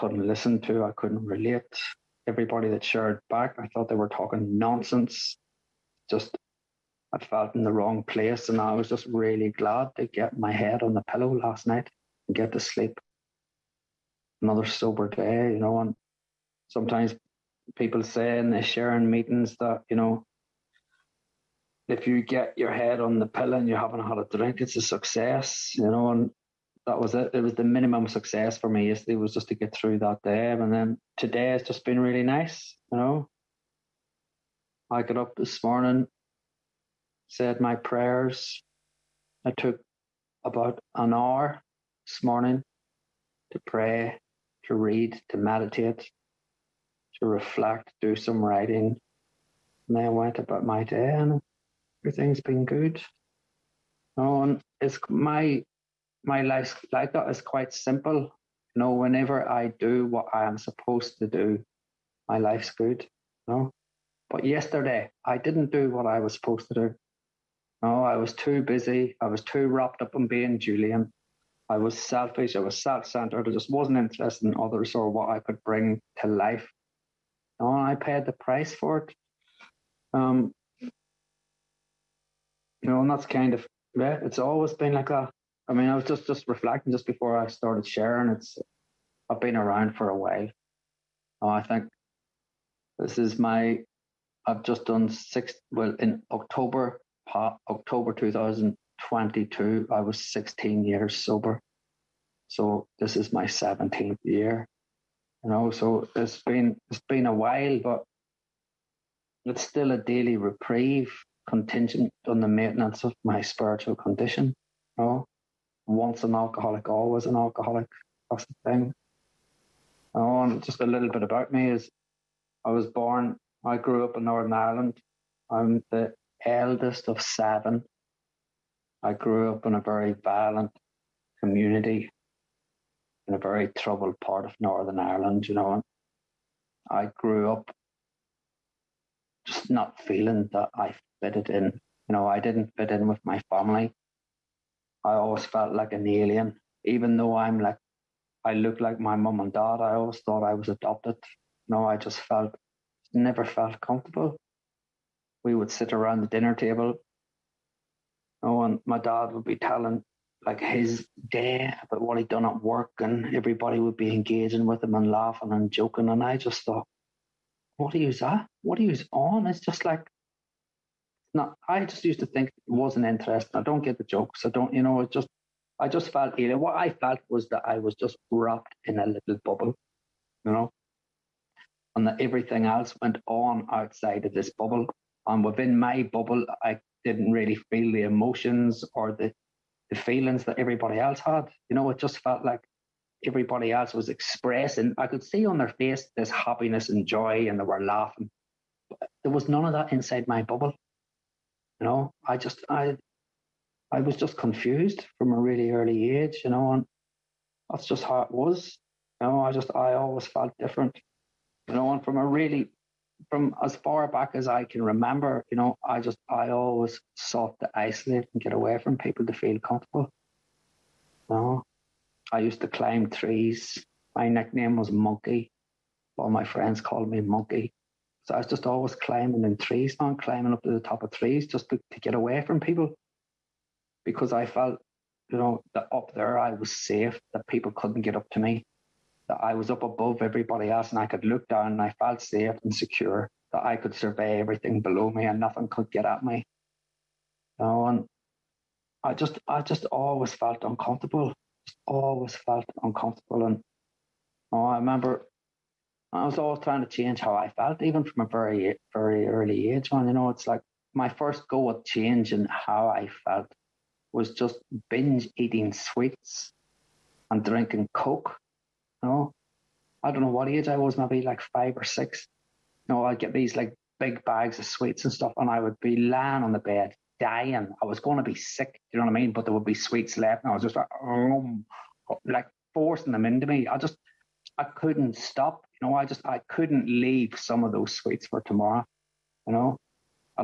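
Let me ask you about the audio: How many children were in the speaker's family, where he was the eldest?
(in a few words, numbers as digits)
7.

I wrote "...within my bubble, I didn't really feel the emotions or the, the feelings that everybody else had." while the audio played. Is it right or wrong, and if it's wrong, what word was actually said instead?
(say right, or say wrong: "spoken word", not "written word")
right.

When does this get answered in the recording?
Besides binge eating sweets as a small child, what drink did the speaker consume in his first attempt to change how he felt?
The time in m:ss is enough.
4:27.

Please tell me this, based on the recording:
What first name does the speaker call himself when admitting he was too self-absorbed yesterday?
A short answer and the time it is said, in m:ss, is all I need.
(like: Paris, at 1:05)
Julian, at 1:10.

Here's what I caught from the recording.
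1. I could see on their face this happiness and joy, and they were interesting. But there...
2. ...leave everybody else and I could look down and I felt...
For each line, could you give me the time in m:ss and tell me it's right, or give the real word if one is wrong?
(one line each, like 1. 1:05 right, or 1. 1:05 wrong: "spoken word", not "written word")
1. 3:14 wrong: "laughing", not "interesting"
2. 3:59 wrong: "above", not "leave".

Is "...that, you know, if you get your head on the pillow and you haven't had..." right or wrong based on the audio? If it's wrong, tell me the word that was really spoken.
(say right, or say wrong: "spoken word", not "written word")
right.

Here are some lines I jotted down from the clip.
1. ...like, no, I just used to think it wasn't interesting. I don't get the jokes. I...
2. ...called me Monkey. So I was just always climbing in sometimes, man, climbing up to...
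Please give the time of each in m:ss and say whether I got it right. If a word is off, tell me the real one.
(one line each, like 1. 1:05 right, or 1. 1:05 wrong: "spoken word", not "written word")
1. 2:49 right
2. 3:46 wrong: "trees", not "sometimes".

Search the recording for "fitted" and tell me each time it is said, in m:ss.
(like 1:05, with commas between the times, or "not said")
2:21.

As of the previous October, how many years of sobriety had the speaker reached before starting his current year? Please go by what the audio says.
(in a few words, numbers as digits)
16 years.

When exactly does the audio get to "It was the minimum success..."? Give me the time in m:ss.
0:27.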